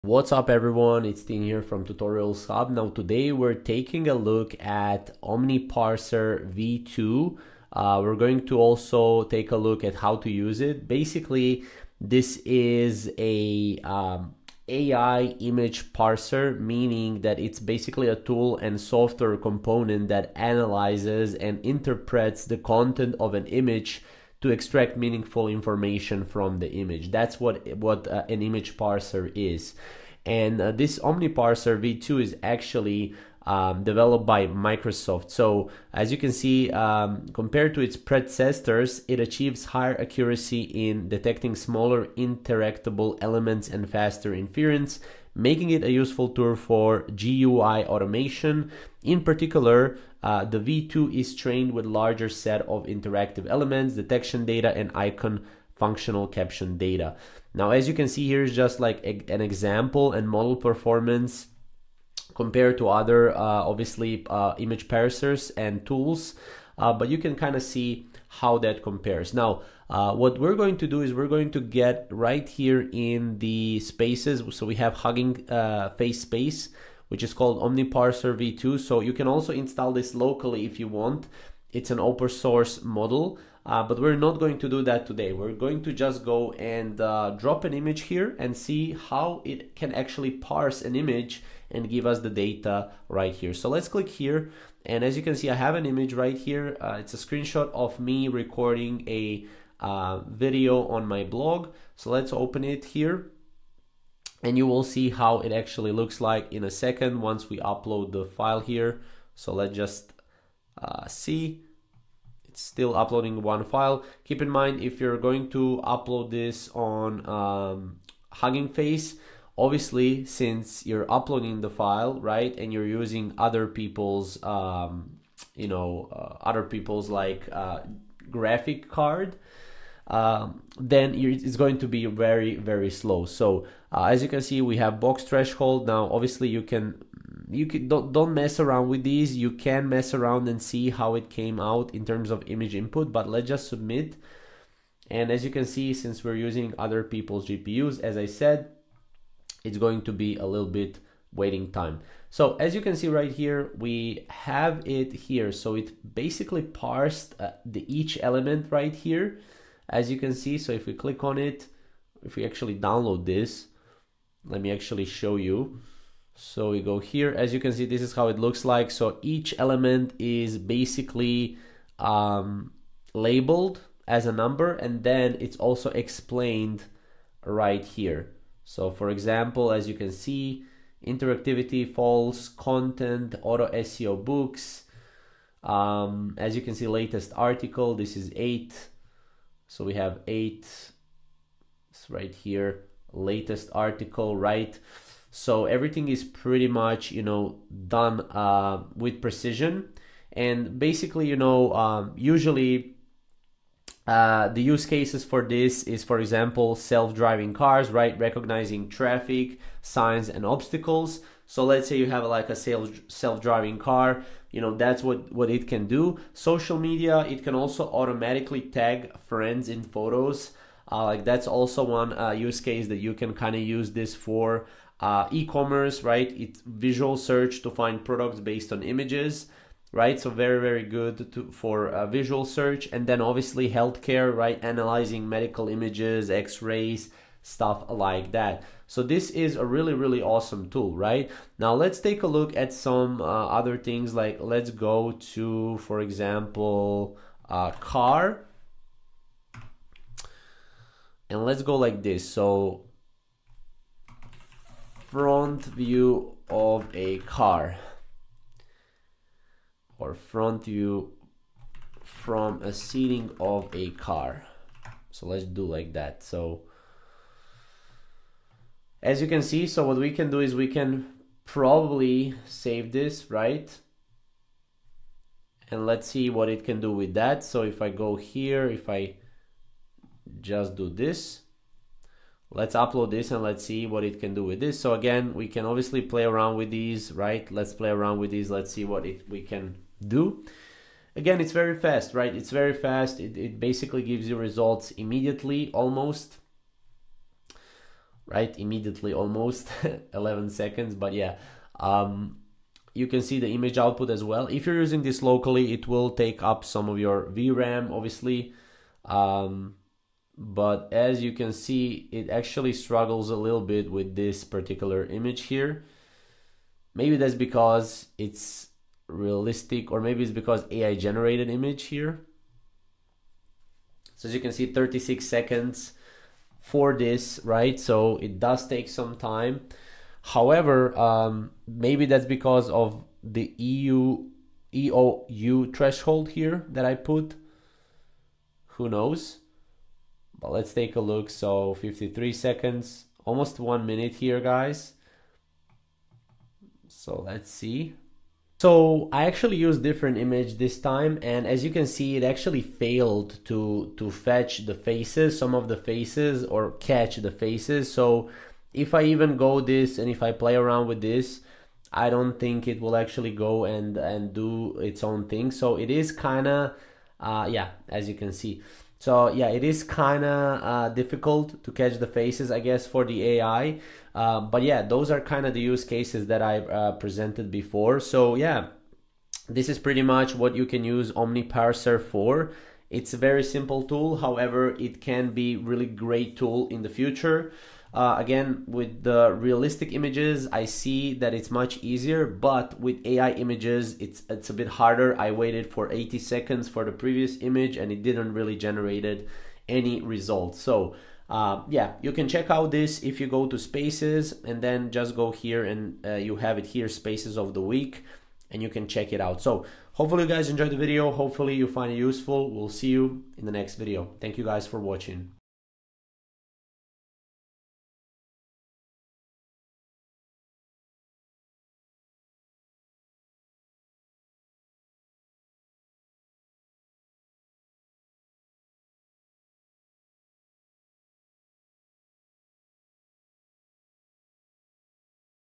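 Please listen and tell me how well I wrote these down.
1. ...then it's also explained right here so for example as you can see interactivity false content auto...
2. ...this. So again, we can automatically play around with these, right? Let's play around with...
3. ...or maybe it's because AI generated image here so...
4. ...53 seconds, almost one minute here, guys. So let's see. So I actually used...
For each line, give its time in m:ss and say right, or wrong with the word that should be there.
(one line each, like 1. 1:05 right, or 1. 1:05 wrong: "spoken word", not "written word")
1. 2:55 right
2. 4:44 wrong: "obviously", not "automatically"
3. 5:19 right
4. 5:41 right.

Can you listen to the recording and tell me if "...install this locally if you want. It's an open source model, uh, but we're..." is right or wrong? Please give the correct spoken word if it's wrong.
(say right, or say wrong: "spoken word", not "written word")
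right.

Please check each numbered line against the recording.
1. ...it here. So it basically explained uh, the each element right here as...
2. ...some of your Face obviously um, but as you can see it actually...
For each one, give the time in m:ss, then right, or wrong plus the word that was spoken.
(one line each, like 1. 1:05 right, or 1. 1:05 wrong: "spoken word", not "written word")
1. 2:34 wrong: "parsed", not "explained"
2. 5:06 wrong: "VRAM", not "Face".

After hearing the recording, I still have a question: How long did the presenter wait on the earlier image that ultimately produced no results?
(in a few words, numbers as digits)
80 seconds.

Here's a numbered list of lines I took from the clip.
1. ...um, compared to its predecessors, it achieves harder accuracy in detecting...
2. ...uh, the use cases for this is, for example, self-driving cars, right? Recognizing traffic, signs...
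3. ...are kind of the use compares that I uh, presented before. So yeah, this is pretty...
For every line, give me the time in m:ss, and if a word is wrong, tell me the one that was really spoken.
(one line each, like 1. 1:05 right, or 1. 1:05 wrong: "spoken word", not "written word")
1. 0:36 wrong: "higher", not "harder"
2. 3:24 right
3. 6:15 wrong: "cases", not "compares".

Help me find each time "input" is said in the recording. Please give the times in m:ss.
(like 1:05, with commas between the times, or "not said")
2:22.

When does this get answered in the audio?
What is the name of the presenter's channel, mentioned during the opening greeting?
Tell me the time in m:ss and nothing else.
0:01.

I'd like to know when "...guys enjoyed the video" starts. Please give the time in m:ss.
6:50.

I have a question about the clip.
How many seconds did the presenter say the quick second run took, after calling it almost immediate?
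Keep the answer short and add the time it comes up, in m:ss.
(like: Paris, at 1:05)
11, at 5:00.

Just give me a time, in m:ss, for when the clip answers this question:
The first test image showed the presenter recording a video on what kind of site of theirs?
1:41.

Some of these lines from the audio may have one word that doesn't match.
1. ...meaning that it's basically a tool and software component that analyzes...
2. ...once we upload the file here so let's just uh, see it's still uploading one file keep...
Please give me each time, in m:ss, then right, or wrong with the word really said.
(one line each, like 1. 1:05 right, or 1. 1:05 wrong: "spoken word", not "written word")
1. 0:16 right
2. 1:47 right.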